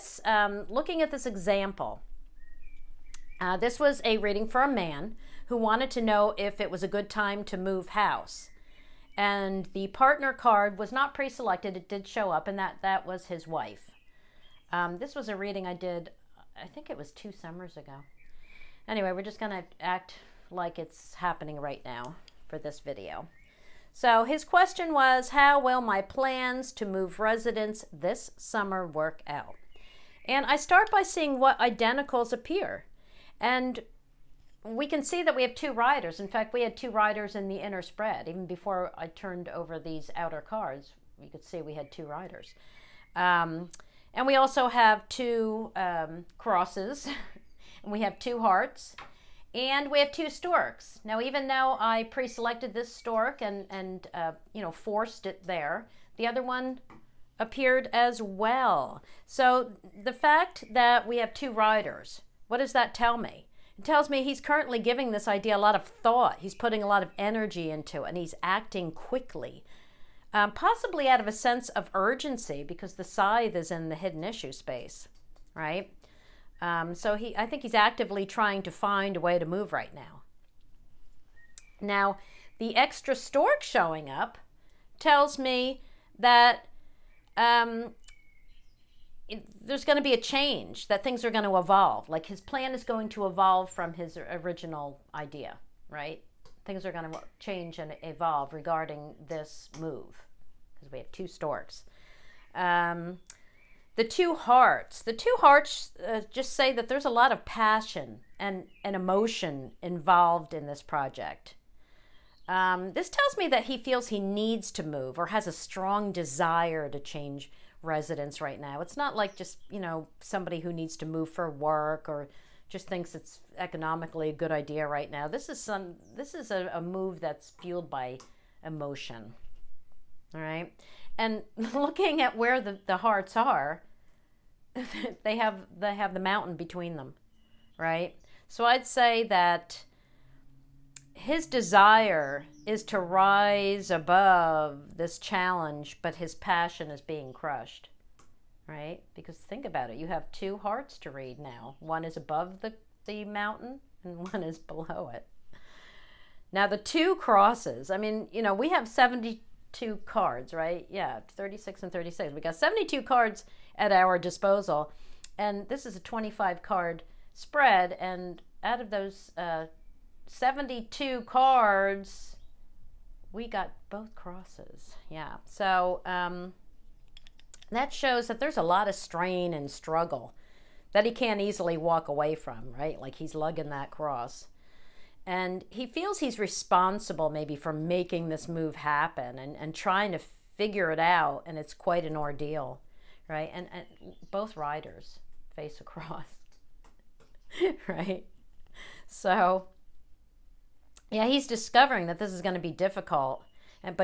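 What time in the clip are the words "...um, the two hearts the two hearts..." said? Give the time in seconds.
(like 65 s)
102 s.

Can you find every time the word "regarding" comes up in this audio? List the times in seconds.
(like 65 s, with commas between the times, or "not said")
98 s.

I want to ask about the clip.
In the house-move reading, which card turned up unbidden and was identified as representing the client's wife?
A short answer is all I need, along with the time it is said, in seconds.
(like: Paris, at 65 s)
Partner card, at 9 s.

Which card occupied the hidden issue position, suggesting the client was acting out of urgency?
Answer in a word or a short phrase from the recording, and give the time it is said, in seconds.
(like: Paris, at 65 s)
Scythe, at 73 s.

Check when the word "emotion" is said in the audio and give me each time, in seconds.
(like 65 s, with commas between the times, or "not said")
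108 s, 128 s.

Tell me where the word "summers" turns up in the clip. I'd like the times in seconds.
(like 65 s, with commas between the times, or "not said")
17 s, 28 s.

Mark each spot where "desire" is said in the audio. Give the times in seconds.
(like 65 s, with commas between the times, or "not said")
116 s, 141 s.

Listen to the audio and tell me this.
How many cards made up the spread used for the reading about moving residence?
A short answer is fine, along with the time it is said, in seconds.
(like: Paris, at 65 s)
25, at 166 s.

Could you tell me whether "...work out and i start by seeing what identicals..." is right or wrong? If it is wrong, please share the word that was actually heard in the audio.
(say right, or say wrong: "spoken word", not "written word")
right.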